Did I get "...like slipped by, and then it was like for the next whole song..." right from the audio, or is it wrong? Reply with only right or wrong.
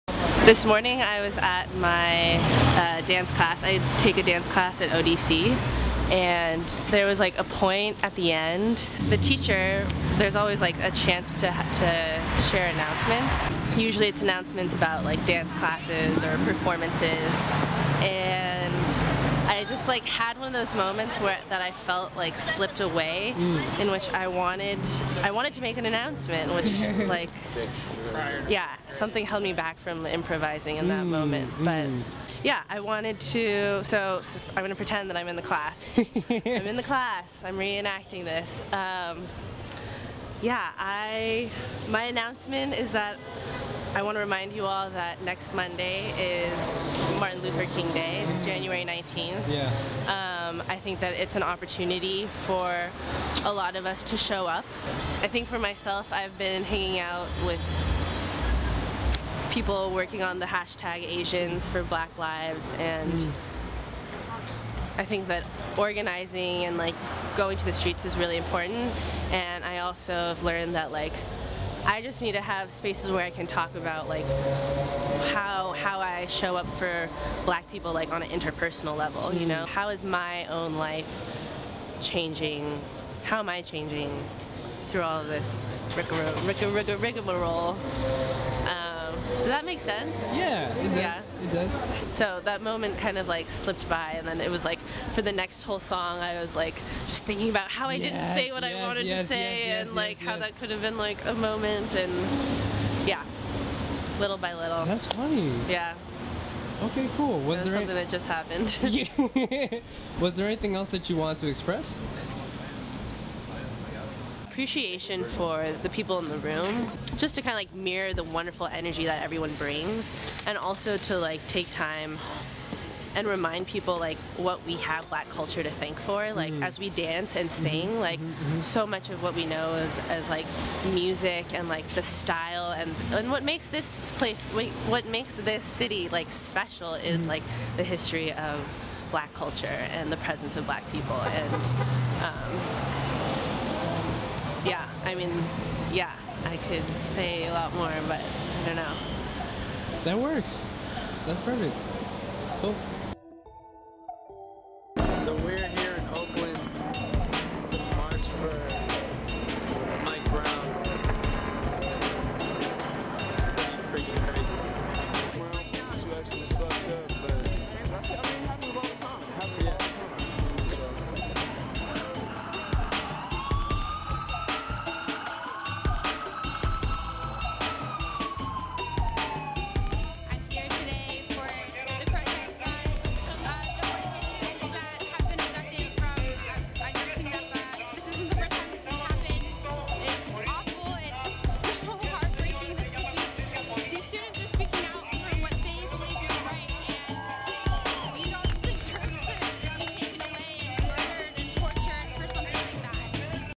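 right.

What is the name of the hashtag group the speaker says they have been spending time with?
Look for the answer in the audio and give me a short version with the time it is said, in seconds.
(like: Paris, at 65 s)
Asians for Black Lives, at 61 s.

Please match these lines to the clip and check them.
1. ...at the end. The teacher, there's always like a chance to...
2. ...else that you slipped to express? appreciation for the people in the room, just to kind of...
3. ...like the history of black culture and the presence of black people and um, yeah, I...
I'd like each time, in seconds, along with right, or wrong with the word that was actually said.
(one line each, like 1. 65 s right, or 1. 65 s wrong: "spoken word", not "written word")
1. 8 s right
2. 110 s wrong: "wanted", not "slipped"
3. 137 s right.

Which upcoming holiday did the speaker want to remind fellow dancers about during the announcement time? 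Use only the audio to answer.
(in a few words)
Martin Luther King Day.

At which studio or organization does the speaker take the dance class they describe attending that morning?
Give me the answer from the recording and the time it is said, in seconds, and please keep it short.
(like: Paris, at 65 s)
ODC, at 4 s.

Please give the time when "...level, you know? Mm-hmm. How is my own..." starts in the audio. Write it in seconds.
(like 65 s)
78 s.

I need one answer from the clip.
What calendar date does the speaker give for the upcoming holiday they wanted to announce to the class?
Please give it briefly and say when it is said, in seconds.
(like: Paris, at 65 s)
January 19th, at 48 s.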